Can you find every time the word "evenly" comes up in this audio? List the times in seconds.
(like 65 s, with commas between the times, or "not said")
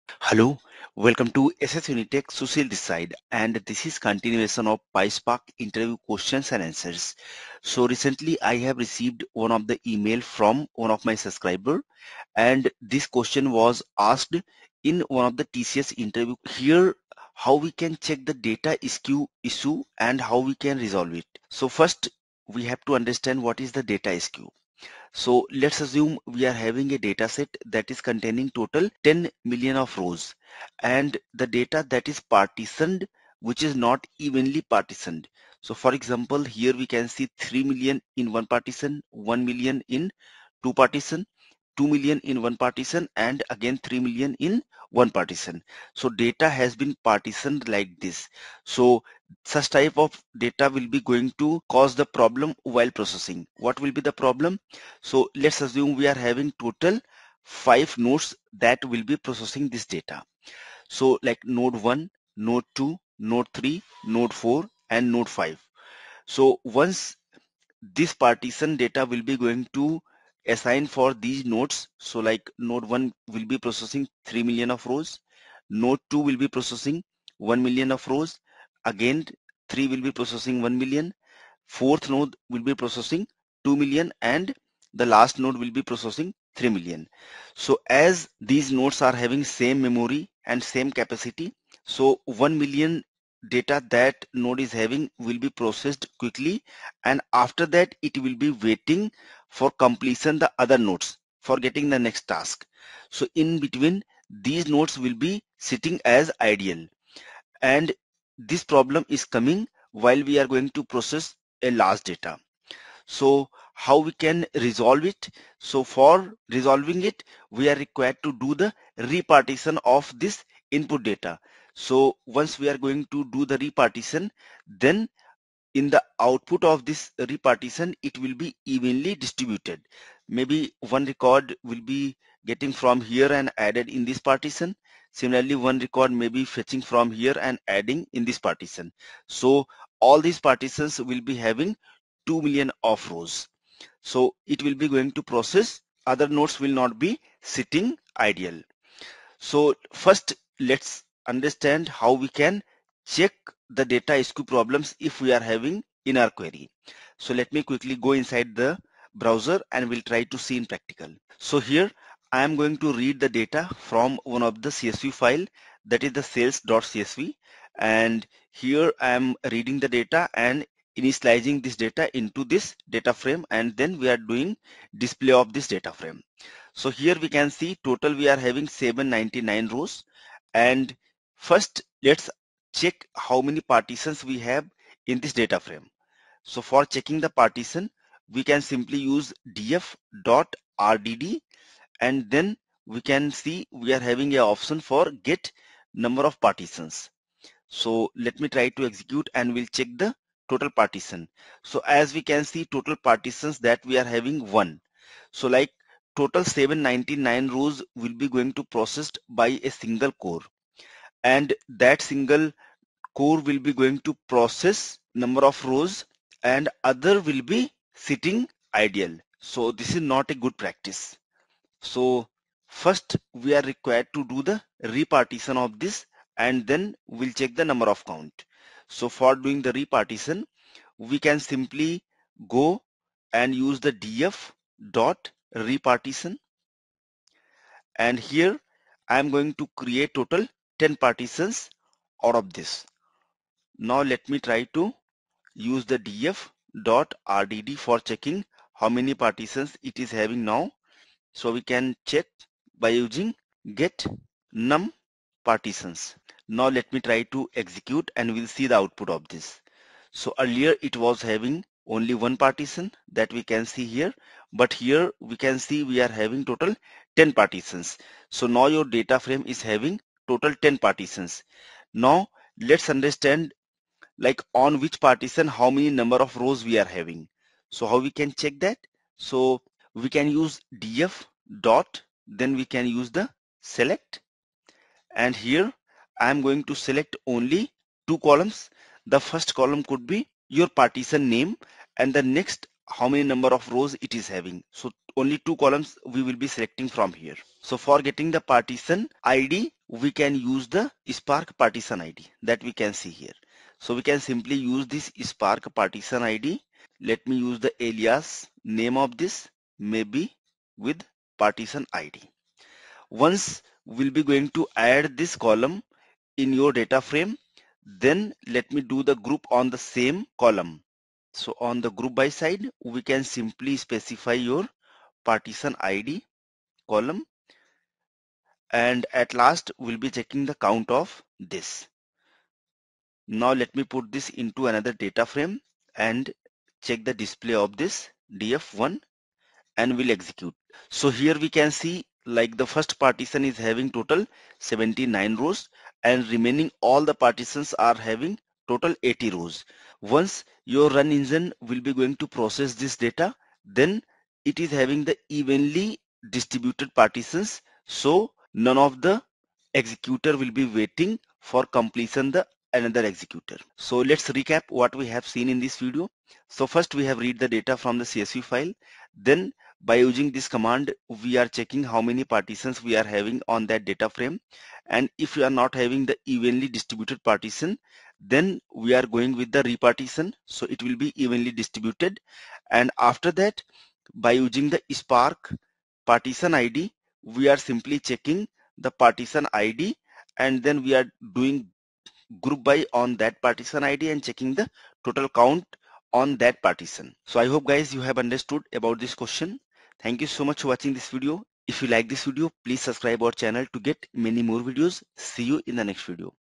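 34 s, 128 s, 355 s, 376 s, 381 s.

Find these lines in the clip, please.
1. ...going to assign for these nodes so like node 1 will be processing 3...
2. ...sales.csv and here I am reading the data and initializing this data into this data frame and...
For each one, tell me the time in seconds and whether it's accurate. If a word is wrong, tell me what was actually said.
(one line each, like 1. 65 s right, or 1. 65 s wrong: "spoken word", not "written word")
1. 69 s right
2. 166 s right.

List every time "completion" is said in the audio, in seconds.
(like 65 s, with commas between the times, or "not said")
99 s, 361 s.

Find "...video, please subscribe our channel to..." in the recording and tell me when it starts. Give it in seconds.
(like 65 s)
402 s.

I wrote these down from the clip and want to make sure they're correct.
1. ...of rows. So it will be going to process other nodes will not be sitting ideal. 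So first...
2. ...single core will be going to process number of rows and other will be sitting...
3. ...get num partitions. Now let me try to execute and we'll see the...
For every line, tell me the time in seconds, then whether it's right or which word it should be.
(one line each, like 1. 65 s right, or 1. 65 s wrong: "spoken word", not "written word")
1. 142 s right
2. 212 s right
3. 253 s right.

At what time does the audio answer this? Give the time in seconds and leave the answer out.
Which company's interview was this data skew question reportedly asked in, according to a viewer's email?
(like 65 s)
15 s.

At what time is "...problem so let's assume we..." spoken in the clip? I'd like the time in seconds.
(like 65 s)
54 s.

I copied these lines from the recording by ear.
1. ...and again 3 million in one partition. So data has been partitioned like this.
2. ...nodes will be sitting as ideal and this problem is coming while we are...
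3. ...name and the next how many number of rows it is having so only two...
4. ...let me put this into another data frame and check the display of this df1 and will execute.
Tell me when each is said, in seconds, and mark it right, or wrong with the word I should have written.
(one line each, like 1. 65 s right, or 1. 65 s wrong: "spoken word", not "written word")
1. 43 s right
2. 104 s right
3. 291 s right
4. 333 s right.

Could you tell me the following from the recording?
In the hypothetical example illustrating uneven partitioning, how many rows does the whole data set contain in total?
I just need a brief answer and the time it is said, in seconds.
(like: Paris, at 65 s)
10 million, at 29 s.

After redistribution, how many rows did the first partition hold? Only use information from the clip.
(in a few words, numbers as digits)
79.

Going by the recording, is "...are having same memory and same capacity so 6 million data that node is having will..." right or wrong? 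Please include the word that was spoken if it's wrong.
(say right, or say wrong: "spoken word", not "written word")
wrong: "1", not "6".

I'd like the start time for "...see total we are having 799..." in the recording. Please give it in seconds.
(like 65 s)
177 s.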